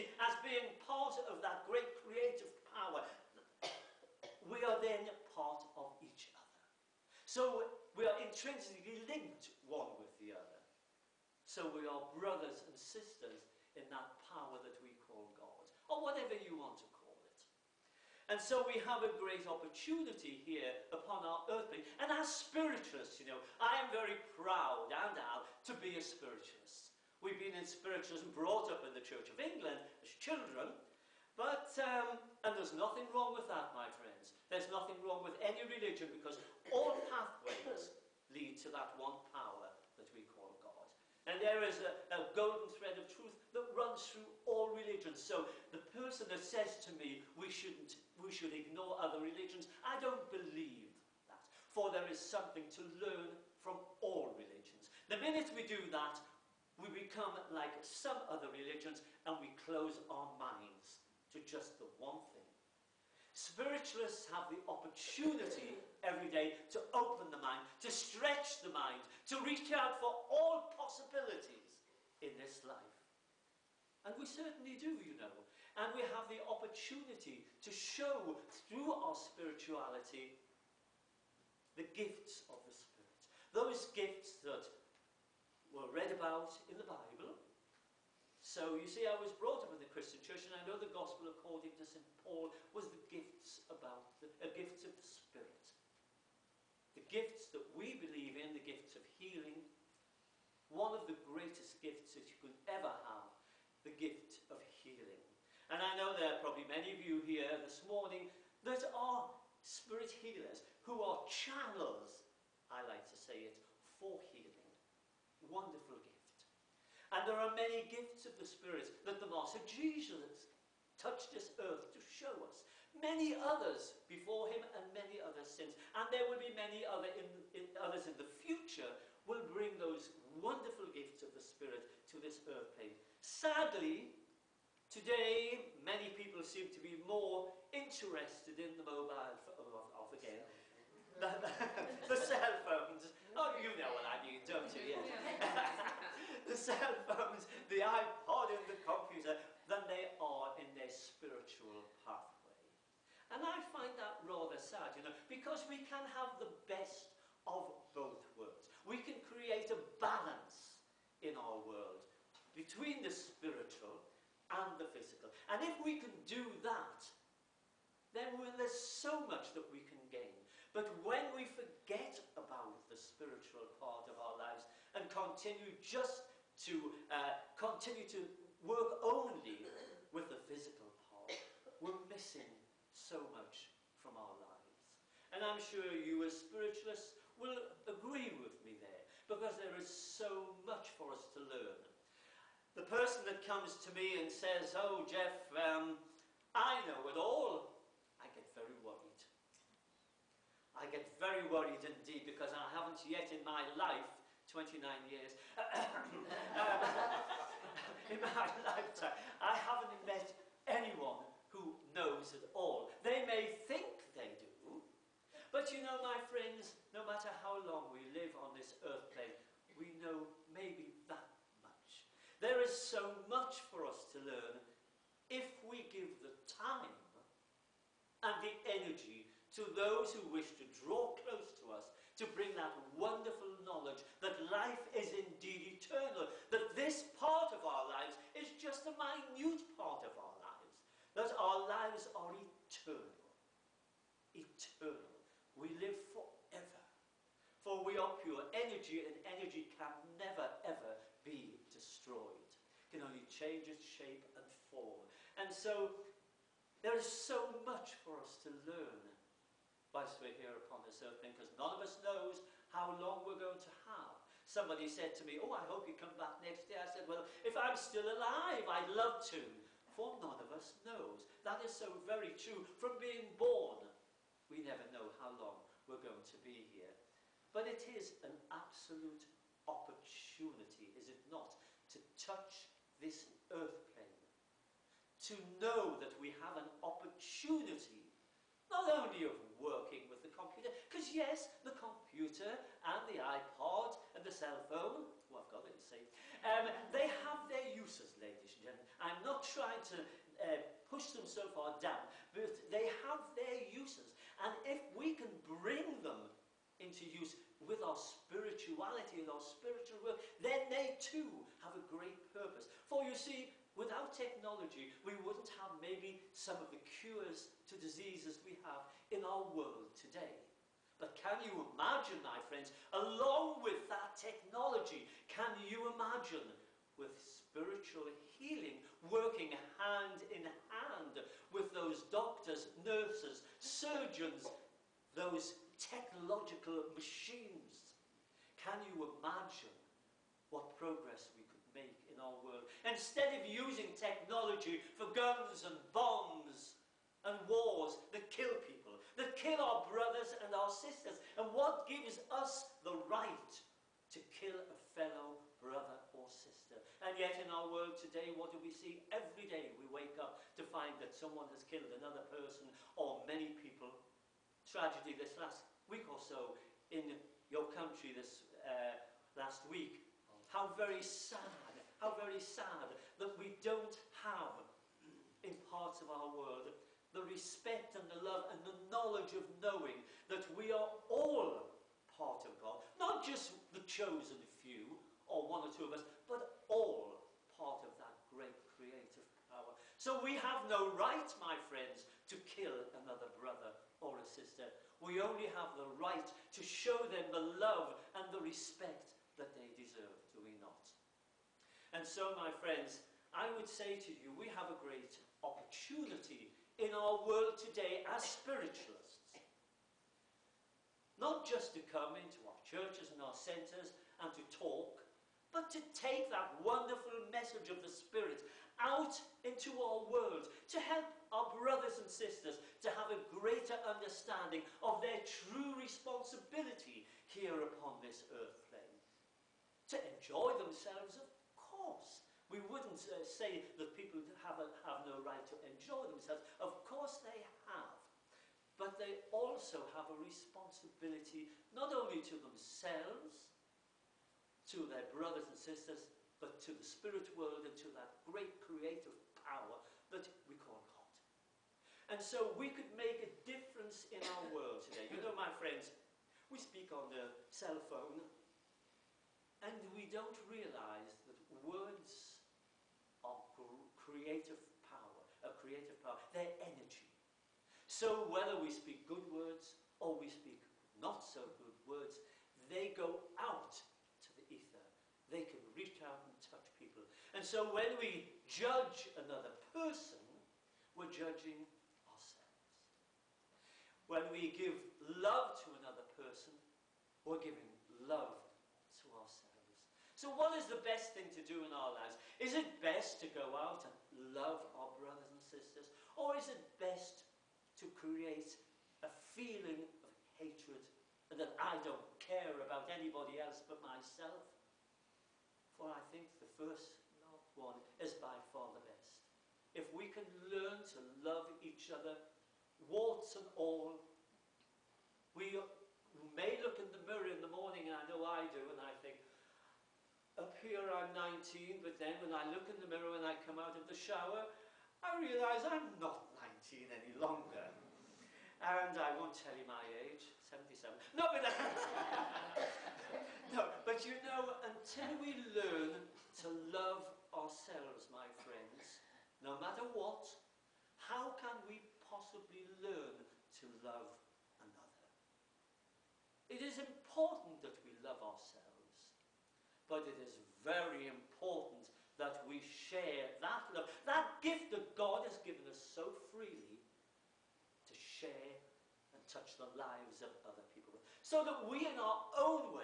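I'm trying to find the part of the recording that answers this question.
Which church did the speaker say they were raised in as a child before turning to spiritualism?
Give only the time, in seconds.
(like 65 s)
29 s.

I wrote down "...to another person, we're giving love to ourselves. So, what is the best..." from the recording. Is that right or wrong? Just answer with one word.
right.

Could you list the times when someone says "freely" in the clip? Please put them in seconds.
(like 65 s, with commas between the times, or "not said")
556 s.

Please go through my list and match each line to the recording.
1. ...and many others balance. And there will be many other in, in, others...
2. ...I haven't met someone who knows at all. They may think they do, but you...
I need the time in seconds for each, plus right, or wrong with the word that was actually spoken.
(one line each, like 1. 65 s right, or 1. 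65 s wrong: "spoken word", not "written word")
1. 124 s wrong: "since", not "balance"
2. 209 s wrong: "anyone", not "someone".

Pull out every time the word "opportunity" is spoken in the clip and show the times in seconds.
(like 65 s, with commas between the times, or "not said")
19 s, 64 s, 76 s, 279 s, 286 s, 405 s.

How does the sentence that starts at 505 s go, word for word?
For I think the first one is by far the best.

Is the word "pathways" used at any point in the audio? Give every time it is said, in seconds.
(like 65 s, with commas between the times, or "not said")
37 s, 152 s.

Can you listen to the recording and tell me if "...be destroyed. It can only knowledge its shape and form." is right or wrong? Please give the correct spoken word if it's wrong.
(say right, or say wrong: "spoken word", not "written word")
wrong: "change", not "knowledge".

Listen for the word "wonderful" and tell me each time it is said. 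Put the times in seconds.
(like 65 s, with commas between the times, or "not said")
115 s, 130 s, 232 s, 416 s.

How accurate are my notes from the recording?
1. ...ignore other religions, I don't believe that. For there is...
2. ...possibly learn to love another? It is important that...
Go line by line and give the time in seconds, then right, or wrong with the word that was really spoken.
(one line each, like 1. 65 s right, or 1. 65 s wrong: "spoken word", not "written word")
1. 48 s right
2. 542 s right.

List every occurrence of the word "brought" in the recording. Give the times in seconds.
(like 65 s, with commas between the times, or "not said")
28 s, 89 s.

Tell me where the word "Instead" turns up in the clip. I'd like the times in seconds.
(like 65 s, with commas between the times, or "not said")
342 s.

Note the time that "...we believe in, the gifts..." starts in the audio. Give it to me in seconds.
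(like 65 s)
97 s.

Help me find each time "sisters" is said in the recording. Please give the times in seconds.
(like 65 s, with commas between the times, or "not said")
12 s, 350 s, 356 s, 394 s, 422 s, 445 s, 495 s.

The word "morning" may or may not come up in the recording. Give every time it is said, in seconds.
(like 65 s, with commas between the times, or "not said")
107 s, 517 s.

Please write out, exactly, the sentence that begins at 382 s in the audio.
Not just the chosen few or one or two of us, but all part of that great creative power.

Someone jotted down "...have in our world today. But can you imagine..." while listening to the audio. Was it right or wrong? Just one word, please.
right.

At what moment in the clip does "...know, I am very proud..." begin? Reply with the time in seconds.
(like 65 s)
23 s.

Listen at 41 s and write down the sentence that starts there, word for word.
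And there is a, a, golden thread of truth that runs through all religions.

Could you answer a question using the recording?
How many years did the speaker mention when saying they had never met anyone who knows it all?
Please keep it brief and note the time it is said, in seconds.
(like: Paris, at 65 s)
29, at 204 s.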